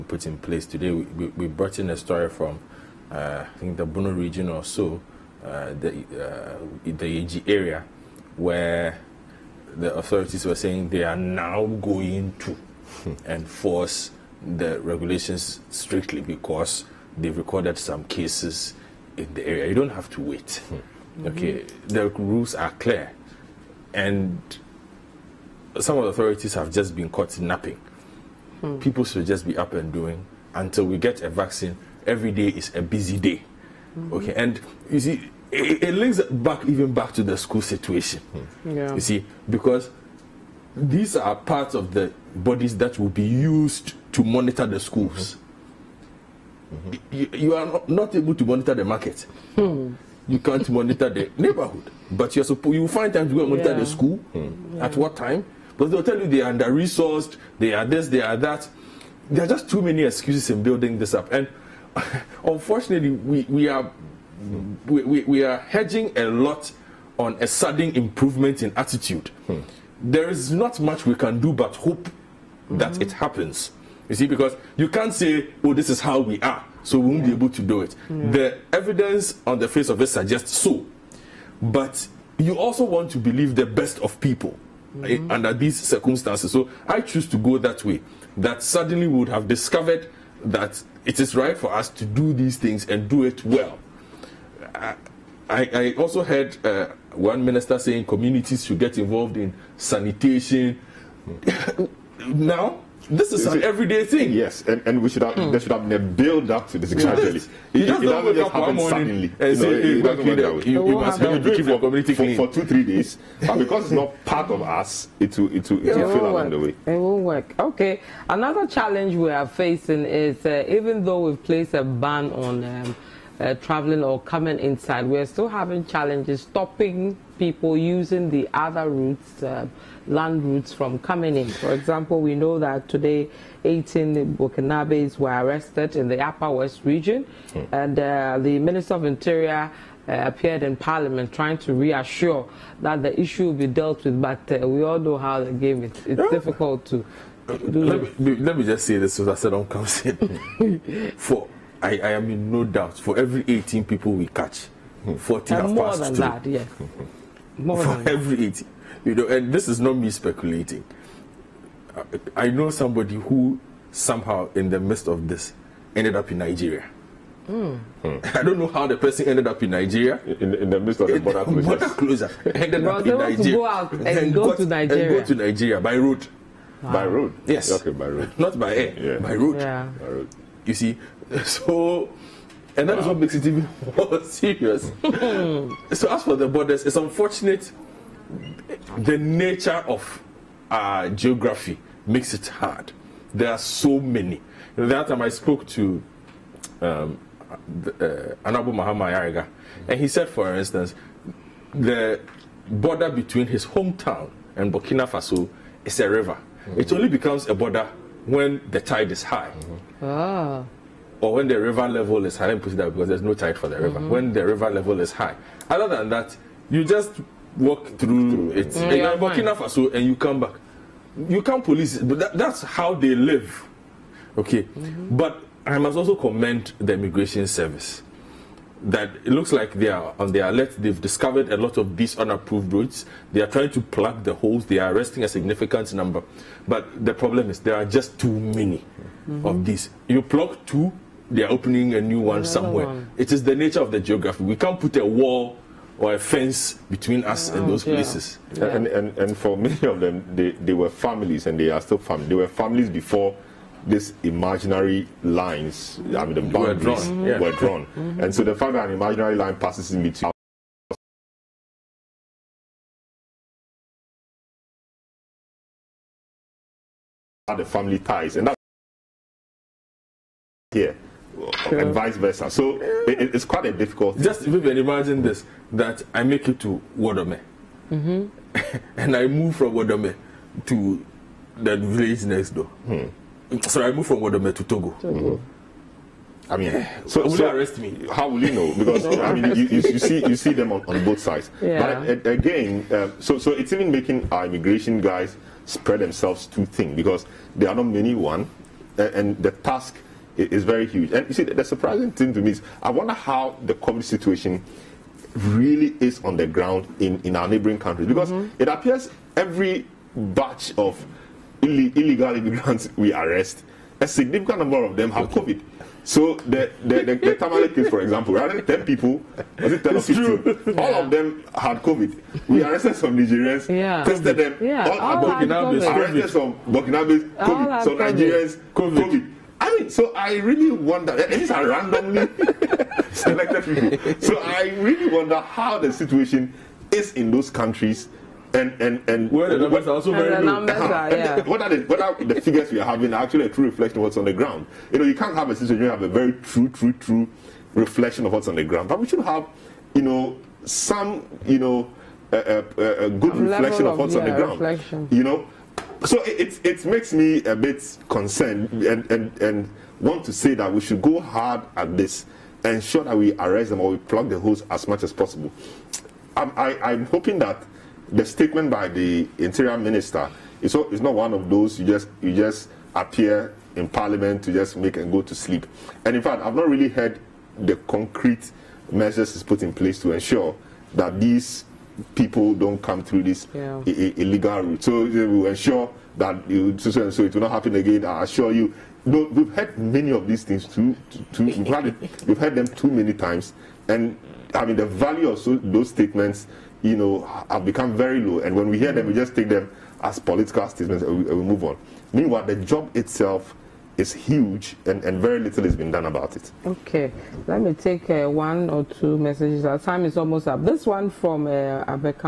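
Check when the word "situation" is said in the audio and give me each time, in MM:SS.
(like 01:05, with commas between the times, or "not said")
00:37, 05:04, 05:35, 05:45.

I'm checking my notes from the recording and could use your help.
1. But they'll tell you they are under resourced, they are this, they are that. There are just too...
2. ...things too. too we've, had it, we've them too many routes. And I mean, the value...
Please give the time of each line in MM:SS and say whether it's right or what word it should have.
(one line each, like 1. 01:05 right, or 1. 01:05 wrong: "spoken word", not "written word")
1. 00:55 right
2. 06:30 wrong: "times", not "routes".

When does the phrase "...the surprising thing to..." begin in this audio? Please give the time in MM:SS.
05:01.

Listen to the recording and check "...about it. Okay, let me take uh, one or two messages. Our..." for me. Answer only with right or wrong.
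right.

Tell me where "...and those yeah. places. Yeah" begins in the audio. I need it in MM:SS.
04:07.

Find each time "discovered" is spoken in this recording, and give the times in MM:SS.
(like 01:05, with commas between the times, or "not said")
01:29, 03:51.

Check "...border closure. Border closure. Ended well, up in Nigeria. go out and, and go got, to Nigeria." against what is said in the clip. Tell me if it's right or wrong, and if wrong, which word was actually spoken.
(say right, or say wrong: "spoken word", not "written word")
right.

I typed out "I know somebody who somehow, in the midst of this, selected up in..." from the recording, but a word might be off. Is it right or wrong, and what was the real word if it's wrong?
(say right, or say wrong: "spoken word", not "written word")
wrong: "ended", not "selected".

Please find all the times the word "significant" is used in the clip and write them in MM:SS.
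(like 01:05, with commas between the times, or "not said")
03:55, 05:14.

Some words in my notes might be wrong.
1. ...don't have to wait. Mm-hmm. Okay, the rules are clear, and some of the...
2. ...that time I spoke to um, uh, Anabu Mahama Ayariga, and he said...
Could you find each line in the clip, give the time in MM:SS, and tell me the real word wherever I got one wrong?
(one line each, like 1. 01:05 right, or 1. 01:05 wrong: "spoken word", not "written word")
1. 00:19 right
2. 03:14 right.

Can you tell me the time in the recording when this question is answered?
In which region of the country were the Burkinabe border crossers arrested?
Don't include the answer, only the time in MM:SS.
02:16.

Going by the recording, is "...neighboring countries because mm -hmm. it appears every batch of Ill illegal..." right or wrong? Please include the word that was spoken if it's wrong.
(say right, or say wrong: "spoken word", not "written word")
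right.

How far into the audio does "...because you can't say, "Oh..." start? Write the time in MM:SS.
01:14.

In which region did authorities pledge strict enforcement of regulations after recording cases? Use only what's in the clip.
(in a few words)
Bono region.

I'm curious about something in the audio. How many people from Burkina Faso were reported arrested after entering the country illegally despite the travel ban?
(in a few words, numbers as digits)
18.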